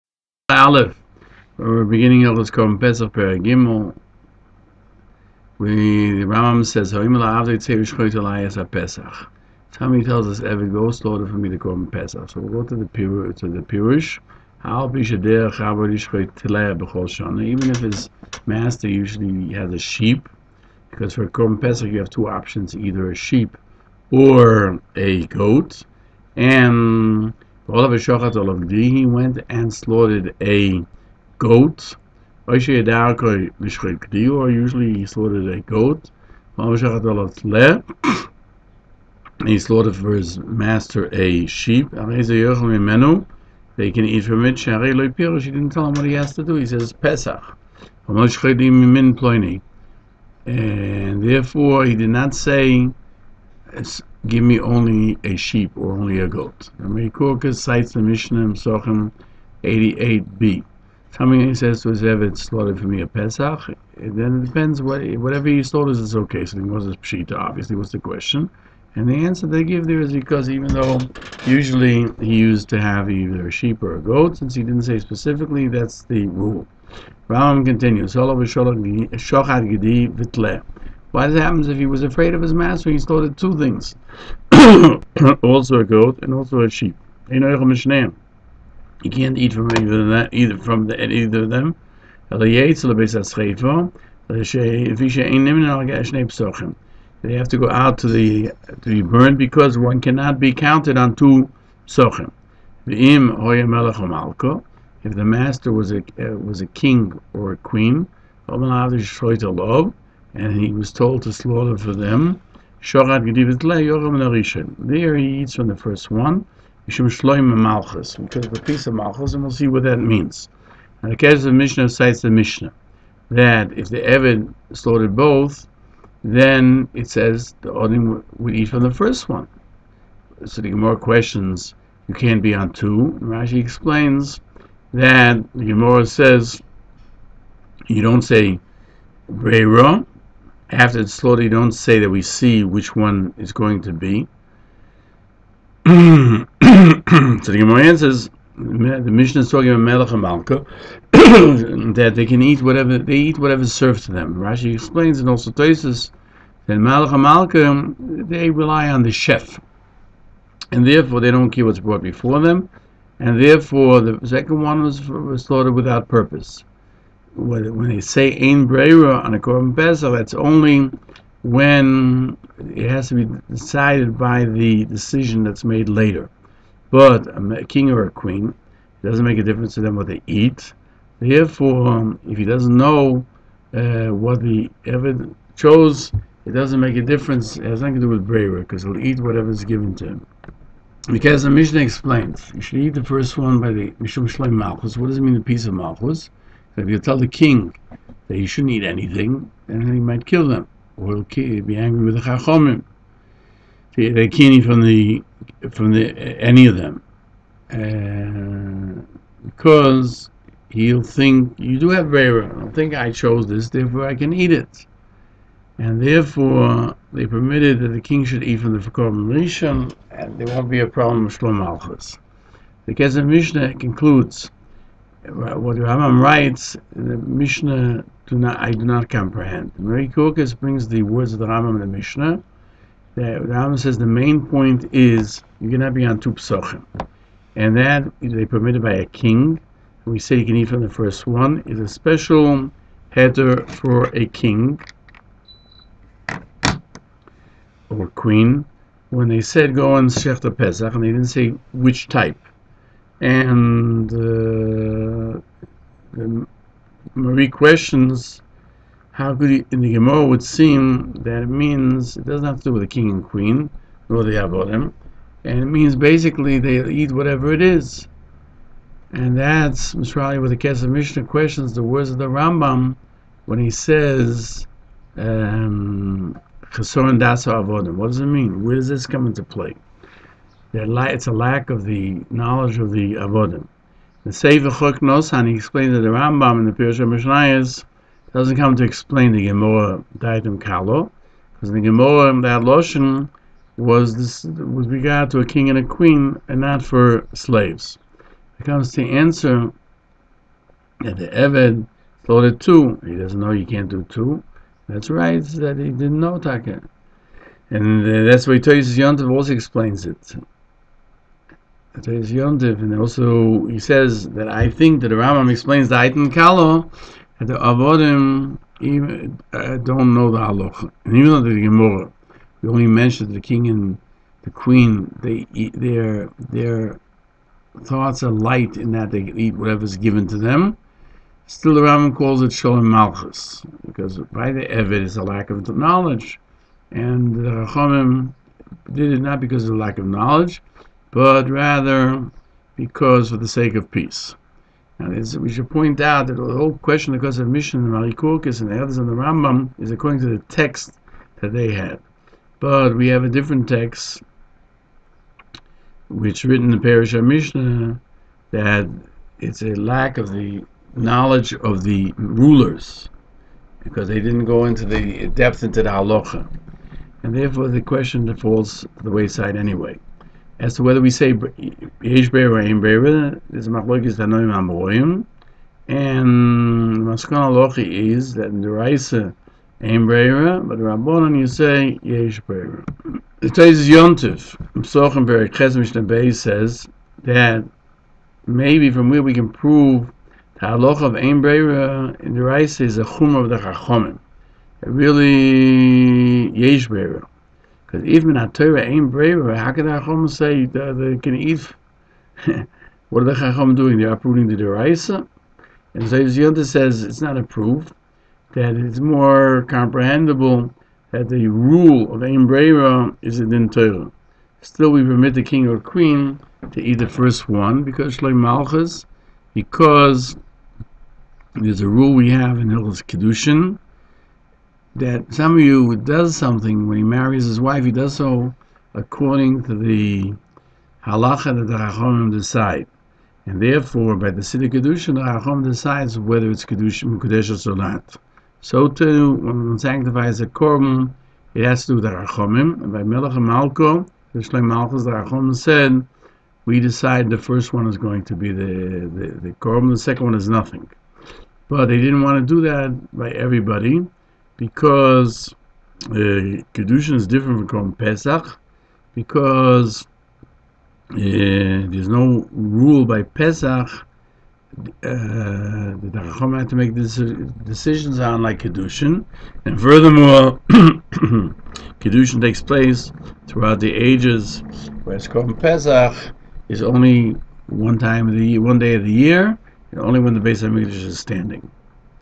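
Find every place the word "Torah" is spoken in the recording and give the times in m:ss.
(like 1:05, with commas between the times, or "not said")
6:38, 6:53.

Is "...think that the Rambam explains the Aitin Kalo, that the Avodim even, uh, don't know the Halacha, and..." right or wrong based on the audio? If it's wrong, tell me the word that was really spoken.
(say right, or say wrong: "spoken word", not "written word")
right.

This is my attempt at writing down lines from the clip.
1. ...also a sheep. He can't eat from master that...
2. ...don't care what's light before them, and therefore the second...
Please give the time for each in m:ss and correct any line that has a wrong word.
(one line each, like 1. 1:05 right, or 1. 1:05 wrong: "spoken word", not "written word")
1. 1:26 wrong: "either", not "master"
2. 2:41 wrong: "brought", not "light".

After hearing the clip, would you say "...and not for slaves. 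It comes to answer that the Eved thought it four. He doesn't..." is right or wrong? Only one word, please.
wrong.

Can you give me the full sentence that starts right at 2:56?
But a king or a queen doesn't make a difference to them what they eat.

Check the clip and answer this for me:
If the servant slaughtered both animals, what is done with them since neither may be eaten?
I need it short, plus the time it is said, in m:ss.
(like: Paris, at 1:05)
burned, at 1:39.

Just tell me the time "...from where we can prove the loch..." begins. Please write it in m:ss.
6:28.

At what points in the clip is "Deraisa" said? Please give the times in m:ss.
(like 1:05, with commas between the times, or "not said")
6:44.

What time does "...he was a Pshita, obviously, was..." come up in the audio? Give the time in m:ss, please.
1:06.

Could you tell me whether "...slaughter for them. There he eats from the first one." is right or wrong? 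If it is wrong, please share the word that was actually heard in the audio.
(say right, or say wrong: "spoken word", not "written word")
right.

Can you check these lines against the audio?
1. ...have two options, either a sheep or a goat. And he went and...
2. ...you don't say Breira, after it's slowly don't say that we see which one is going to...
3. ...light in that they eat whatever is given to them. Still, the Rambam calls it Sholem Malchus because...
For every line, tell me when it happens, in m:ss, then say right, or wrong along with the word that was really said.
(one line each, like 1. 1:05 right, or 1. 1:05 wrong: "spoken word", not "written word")
1. 0:21 right
2. 2:17 right
3. 5:28 right.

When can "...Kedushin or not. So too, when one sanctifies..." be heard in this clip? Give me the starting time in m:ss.
7:16.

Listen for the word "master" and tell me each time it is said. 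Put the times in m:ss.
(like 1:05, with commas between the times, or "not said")
0:18, 0:40, 1:22, 1:45.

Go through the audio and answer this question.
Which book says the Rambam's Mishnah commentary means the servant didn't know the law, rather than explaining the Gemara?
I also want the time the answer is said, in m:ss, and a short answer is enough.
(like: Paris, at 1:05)
Choknosan, at 4:44.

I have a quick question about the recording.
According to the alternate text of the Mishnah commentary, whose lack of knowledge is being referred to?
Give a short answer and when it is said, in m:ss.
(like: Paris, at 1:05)
the rulers, at 6:01.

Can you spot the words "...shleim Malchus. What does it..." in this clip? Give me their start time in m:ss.
3:14.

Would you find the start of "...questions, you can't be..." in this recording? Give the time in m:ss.
2:10.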